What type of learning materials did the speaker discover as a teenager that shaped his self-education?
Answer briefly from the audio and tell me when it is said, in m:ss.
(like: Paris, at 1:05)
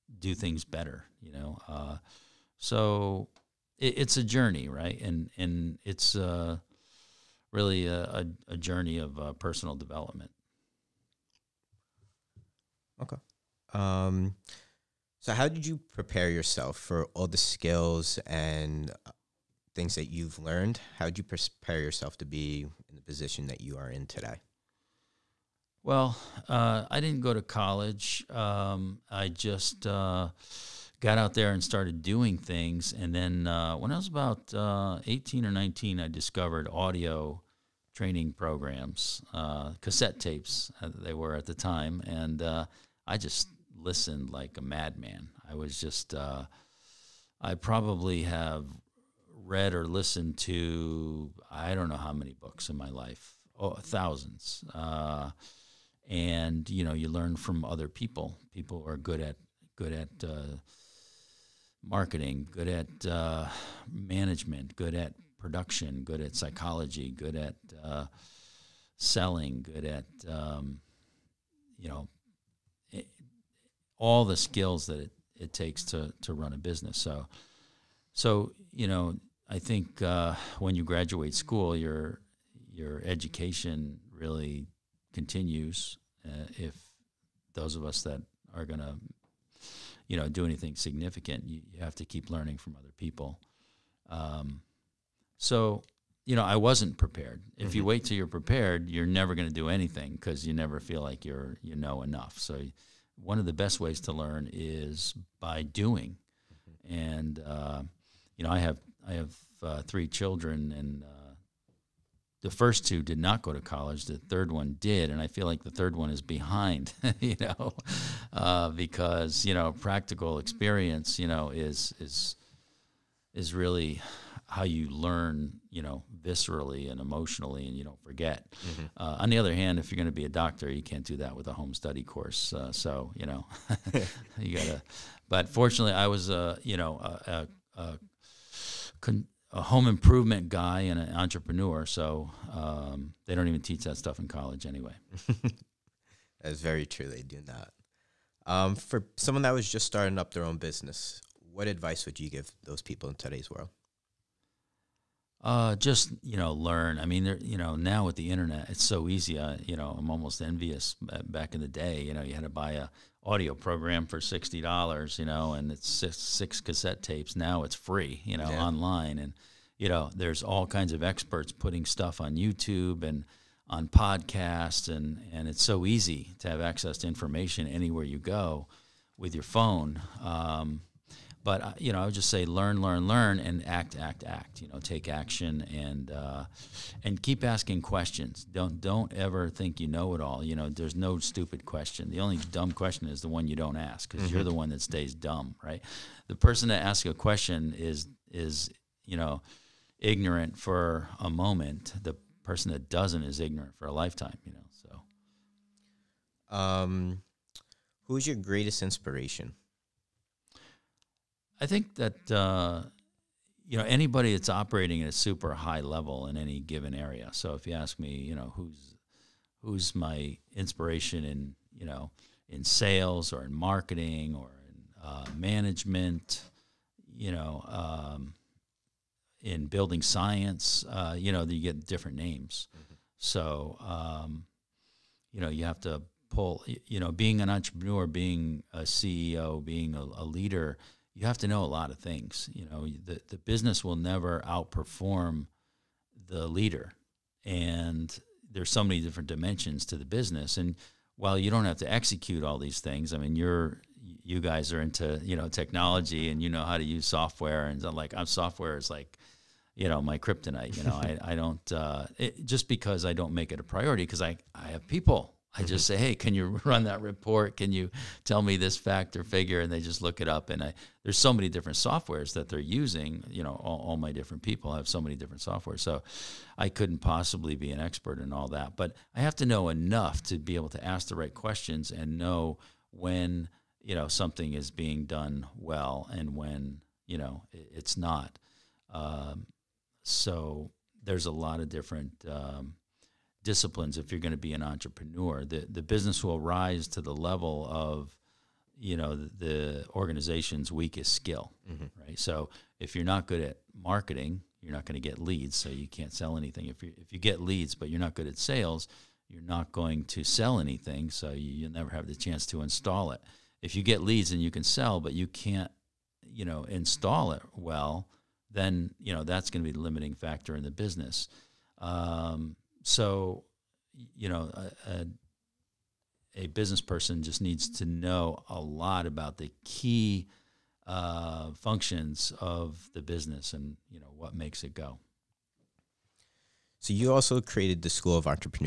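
Audio training programs, at 0:36.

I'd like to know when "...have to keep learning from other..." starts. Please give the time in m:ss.
1:31.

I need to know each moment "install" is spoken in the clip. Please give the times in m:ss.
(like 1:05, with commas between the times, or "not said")
5:12, 5:16.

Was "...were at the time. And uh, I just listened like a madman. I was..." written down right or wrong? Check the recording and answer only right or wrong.
right.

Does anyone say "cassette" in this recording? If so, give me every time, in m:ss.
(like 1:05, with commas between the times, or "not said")
0:39, 2:46.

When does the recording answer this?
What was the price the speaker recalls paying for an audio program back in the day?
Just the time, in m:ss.
2:44.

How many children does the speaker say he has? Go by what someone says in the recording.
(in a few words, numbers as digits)
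3.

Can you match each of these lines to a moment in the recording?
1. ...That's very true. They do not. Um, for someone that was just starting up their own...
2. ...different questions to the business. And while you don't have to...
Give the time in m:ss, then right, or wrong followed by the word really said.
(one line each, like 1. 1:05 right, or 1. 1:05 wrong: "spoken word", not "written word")
1. 2:26 right
2. 4:09 wrong: "dimensions", not "questions".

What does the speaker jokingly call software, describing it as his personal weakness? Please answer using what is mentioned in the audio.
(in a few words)
Kryptonite.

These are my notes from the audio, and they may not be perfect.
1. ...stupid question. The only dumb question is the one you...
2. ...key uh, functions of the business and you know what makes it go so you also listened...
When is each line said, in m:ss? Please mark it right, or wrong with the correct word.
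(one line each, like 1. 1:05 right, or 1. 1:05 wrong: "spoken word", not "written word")
1. 3:11 right
2. 5:29 wrong: "created", not "listened".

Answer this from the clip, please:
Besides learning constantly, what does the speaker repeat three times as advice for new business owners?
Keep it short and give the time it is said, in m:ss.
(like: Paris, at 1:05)
Act, act, act, at 3:03.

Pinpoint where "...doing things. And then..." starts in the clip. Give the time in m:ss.
0:32.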